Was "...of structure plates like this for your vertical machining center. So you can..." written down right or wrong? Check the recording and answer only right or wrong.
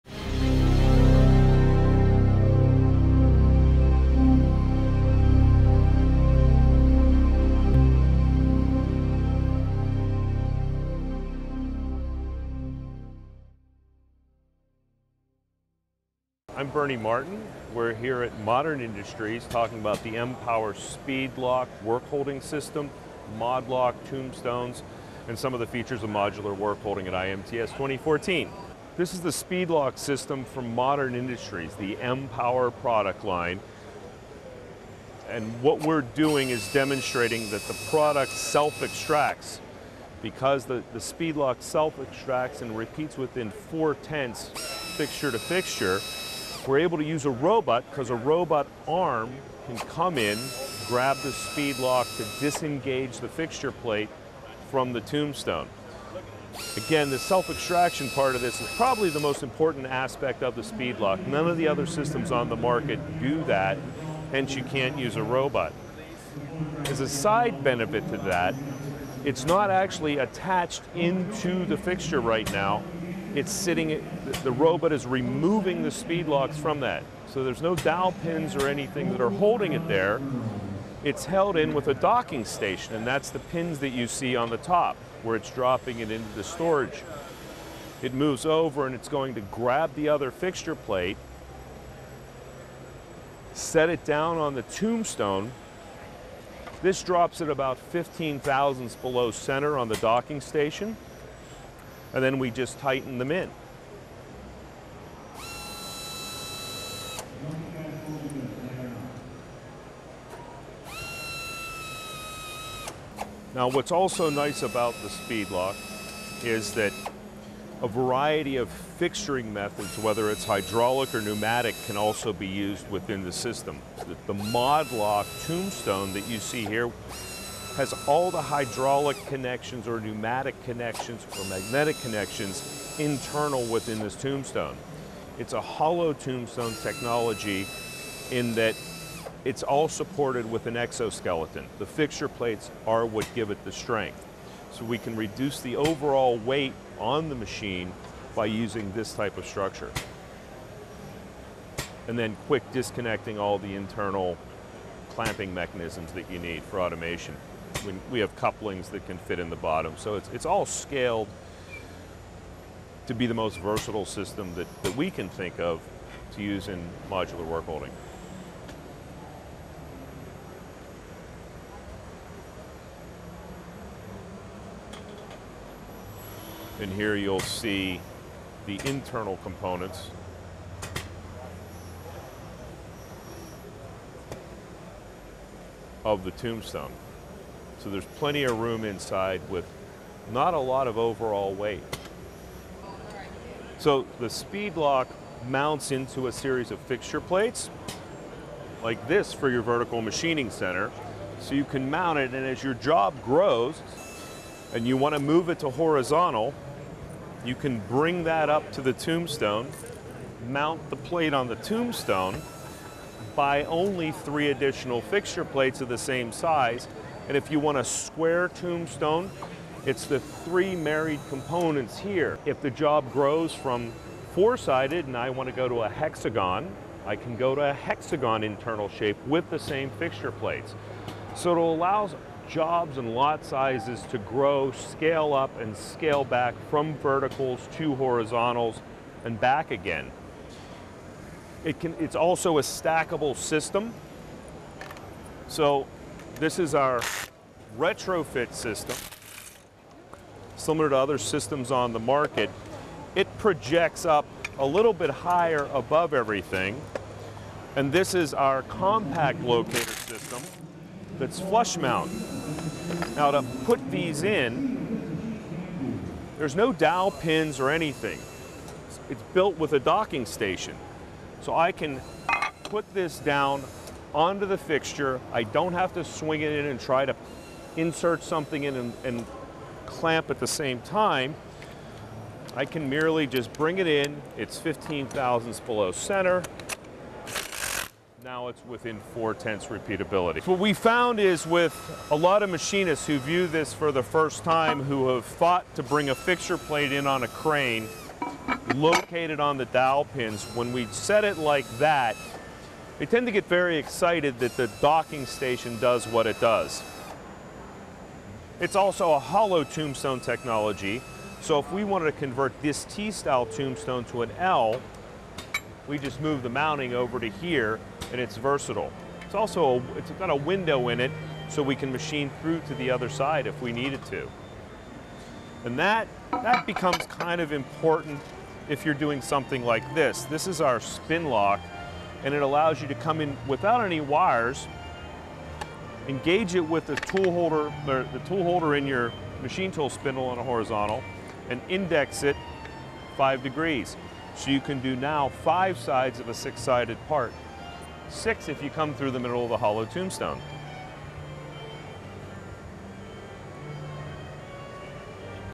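wrong.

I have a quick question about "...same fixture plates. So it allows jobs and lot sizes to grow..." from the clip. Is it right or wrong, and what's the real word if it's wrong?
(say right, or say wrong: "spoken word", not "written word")
right.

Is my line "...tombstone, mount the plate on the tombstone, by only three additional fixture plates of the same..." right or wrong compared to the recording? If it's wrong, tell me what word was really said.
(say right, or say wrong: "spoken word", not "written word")
right.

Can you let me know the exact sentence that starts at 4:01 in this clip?
It can, it's also a stackable system.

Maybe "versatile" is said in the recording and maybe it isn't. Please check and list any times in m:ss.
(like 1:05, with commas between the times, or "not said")
2:43, 5:18.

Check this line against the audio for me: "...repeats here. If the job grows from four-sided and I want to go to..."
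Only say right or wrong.
wrong.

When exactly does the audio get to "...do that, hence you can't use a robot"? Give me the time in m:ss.
1:03.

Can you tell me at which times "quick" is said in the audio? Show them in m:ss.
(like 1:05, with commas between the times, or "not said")
2:32.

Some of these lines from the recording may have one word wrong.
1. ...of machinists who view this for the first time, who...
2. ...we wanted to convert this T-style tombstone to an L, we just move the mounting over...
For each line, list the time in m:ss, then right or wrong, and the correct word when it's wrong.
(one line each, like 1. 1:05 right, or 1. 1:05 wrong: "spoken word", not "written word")
1. 4:52 right
2. 5:11 right.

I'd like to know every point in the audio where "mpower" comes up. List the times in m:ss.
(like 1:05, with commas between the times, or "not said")
0:20, 0:31.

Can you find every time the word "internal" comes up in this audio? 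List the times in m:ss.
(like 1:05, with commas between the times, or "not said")
2:12, 2:33, 2:58, 3:48.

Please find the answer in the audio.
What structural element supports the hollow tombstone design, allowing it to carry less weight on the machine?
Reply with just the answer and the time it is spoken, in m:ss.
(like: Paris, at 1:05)
an exoskeleton, at 2:20.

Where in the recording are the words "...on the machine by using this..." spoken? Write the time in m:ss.
2:26.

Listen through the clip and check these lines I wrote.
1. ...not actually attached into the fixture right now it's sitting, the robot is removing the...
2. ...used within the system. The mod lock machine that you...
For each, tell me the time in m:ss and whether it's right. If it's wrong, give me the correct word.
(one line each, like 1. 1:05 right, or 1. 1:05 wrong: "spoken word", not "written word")
1. 1:09 right
2. 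2:02 wrong: "tombstone", not "machine".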